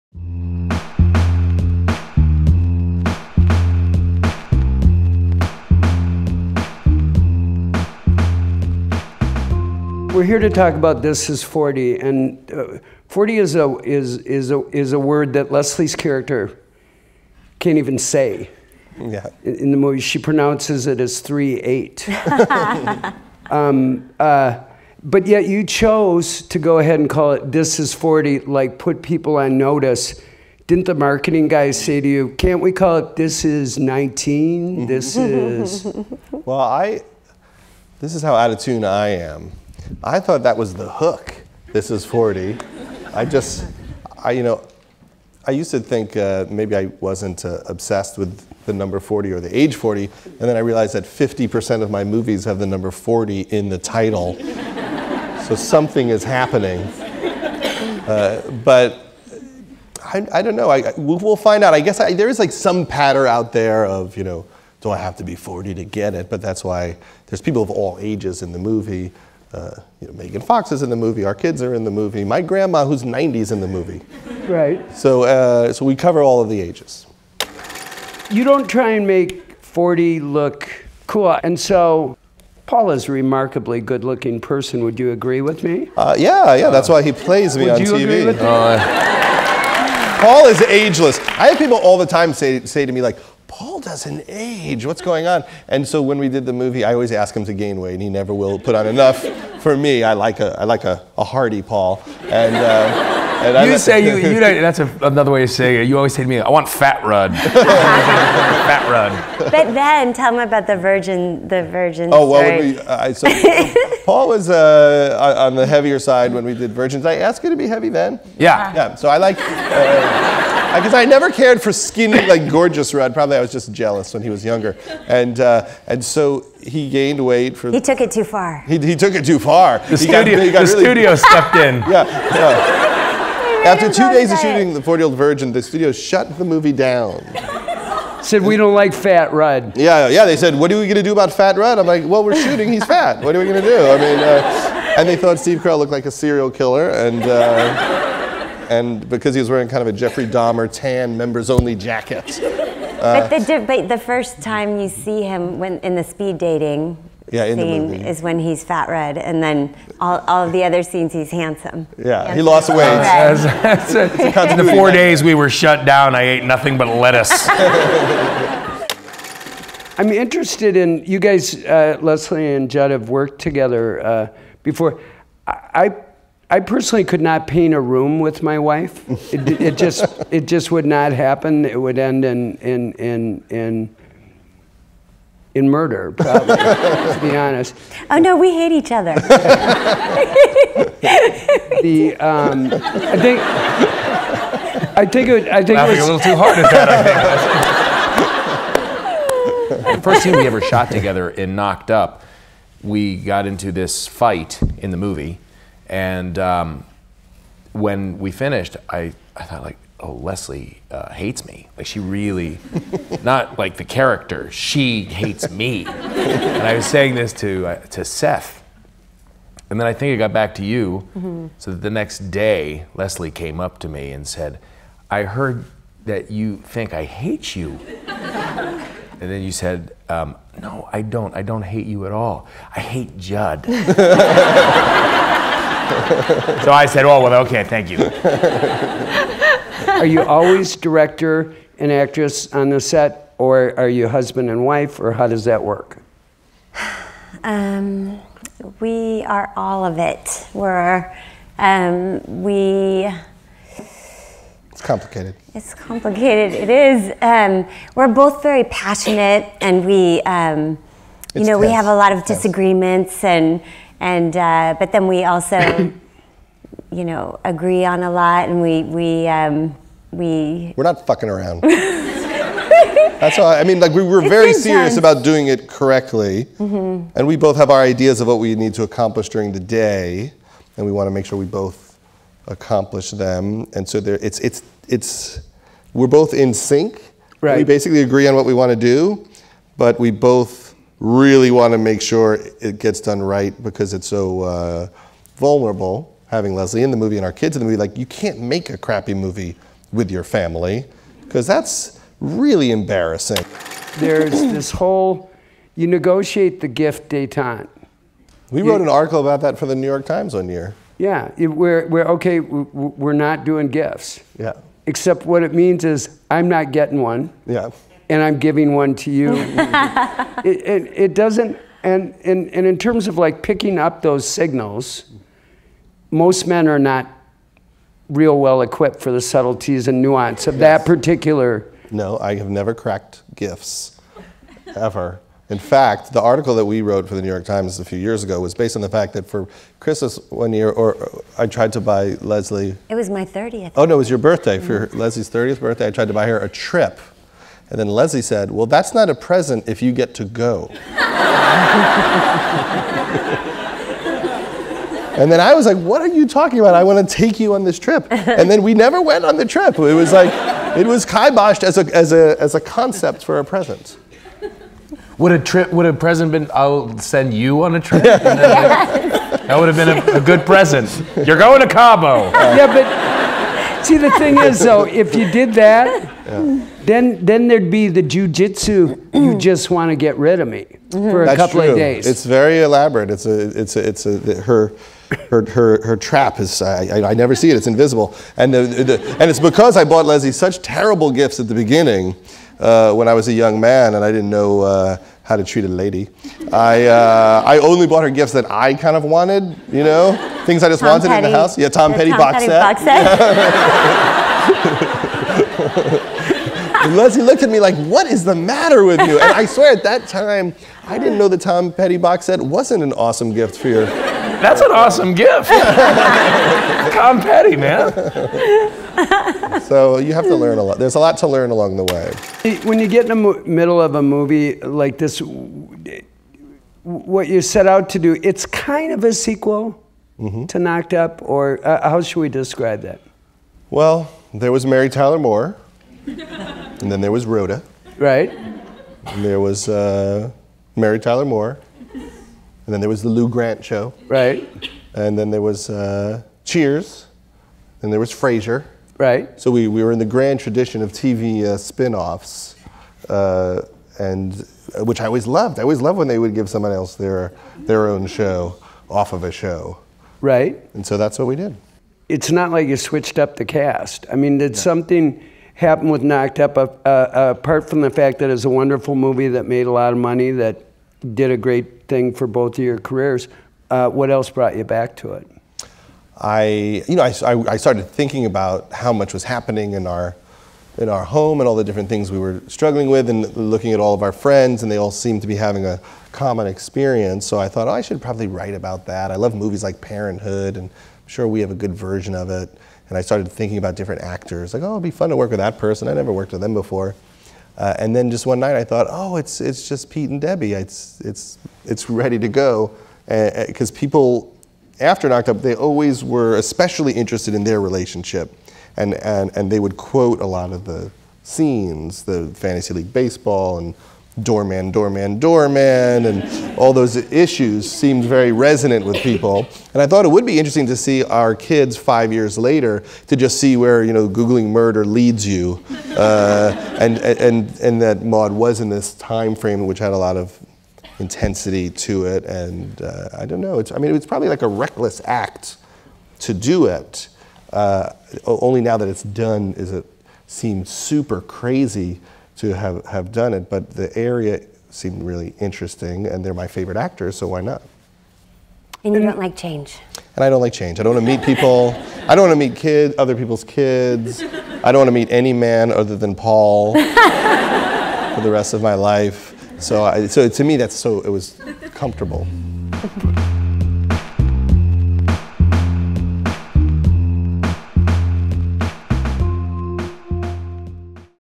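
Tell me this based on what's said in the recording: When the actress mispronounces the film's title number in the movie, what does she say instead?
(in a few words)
38.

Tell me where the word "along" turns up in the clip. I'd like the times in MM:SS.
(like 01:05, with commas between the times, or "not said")
07:01.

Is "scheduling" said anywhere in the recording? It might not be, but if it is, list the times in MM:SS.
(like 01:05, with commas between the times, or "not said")
not said.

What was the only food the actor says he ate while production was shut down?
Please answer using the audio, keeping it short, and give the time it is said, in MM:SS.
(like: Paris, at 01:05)
Lettuce, at 02:46.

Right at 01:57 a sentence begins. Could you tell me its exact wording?
I asked you to be heavy then.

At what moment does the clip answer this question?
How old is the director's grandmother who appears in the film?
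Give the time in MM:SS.
01:13.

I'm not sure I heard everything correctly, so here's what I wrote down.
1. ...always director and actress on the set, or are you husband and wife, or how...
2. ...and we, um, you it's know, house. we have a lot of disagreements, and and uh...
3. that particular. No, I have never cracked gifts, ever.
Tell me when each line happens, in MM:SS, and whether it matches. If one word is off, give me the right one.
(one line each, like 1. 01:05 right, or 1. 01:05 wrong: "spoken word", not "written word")
1. 04:00 right
2. 04:19 wrong: "tense", not "house"
3. 05:30 right.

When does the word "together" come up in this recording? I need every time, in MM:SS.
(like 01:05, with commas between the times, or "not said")
02:53, 03:20.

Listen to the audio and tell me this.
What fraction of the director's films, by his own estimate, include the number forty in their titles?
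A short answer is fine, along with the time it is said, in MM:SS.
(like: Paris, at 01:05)
50%, at 00:51.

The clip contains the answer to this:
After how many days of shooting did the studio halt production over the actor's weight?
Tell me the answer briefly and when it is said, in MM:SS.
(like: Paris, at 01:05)
2, at 02:13.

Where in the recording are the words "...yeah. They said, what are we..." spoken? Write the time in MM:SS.
02:20.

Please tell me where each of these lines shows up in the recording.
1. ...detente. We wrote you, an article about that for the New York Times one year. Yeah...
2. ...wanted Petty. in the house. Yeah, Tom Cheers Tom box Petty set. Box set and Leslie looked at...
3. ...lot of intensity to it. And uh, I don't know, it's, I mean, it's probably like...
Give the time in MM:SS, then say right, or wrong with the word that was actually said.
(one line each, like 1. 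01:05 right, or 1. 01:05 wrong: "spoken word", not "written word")
1. 05:07 right
2. 06:40 wrong: "Petty", not "Cheers"
3. 08:49 right.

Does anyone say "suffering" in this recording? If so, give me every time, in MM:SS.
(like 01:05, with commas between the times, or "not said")
not said.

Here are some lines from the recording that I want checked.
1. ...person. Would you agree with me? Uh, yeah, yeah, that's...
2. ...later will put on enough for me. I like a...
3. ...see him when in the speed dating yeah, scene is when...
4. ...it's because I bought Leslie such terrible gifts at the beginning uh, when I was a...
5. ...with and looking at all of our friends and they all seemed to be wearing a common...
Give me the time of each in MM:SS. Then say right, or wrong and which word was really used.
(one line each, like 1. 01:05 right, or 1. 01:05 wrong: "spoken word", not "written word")
1. 01:24 right
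2. 01:38 wrong: "never", not "later"
3. 02:34 right
4. 06:29 right
5. 08:02 wrong: "having", not "wearing".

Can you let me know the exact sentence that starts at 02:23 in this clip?
I mean, uh, and they thought Steve Carell looked like a serial killer, and.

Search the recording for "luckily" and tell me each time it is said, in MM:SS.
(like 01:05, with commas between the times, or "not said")
not said.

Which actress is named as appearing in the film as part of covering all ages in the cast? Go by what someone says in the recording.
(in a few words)
Megan Fox.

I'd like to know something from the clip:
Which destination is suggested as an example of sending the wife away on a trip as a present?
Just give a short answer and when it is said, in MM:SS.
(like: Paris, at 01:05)
Cabo, at 06:11.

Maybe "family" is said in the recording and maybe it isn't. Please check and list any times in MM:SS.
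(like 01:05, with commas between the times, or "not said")
05:00.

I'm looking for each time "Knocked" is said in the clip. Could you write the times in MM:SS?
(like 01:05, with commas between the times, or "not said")
03:21, 07:10, 07:46, 08:25.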